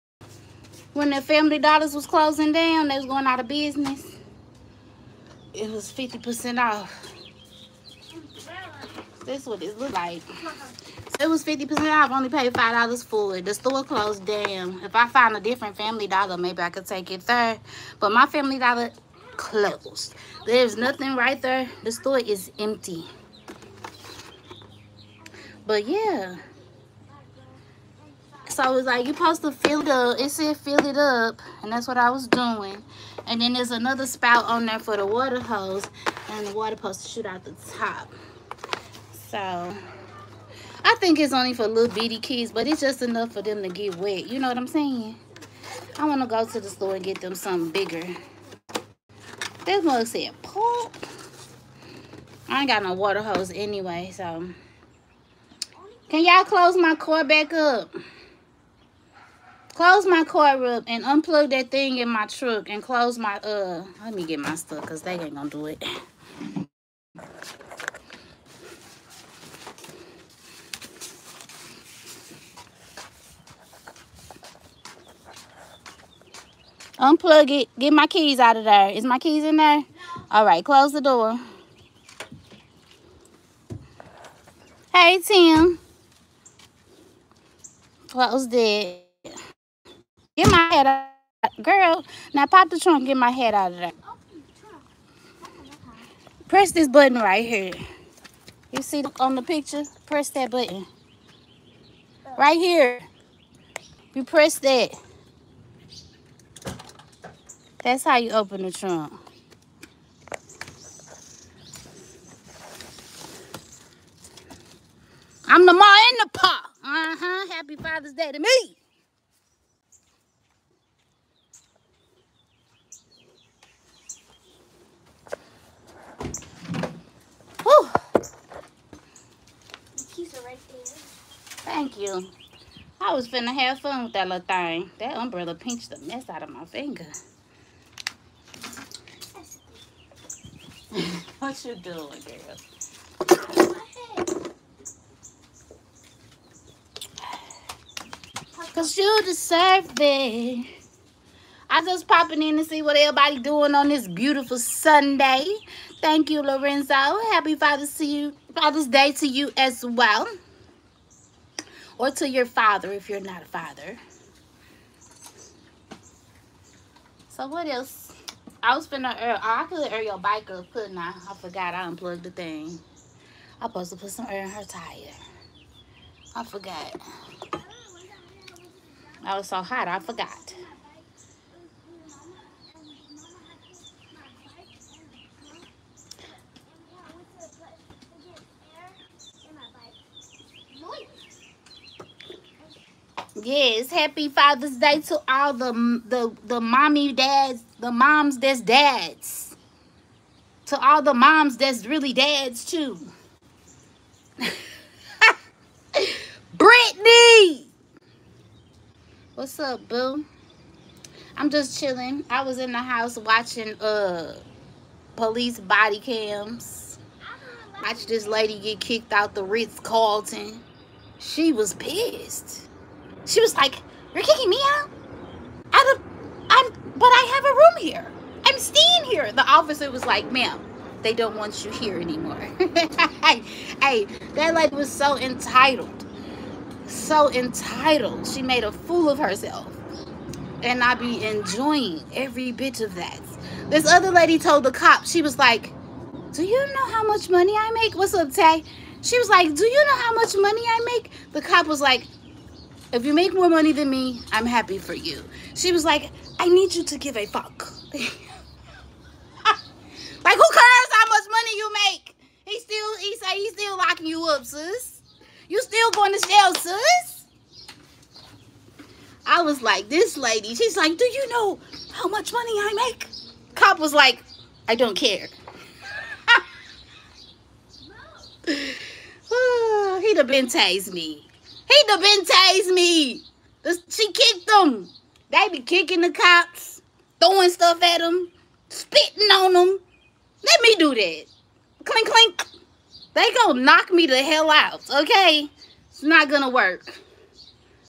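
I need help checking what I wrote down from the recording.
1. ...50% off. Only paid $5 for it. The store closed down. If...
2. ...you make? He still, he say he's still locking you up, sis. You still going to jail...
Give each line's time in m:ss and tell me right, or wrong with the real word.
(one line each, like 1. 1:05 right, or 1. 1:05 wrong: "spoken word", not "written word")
1. 0:11 right
2. 4:21 right.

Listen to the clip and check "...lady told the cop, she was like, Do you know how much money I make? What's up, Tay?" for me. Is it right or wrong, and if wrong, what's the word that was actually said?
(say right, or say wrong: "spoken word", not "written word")
right.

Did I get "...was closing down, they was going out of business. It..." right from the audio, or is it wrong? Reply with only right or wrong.
right.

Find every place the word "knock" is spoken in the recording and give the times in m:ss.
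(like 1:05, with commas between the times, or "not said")
4:53.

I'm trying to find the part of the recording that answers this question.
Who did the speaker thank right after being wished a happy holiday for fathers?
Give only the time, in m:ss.
2:36.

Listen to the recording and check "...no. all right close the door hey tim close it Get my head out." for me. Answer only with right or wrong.
right.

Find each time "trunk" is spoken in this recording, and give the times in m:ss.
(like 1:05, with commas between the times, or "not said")
1:32, 1:48.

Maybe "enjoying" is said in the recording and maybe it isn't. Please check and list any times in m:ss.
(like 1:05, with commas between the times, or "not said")
4:01.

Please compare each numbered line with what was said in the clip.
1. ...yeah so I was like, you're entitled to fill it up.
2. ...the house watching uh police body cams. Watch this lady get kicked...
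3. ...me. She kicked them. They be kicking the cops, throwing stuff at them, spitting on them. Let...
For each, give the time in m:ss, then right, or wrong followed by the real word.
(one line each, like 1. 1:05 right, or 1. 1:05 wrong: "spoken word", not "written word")
1. 0:25 wrong: "supposed", not "entitled"
2. 3:32 right
3. 4:42 right.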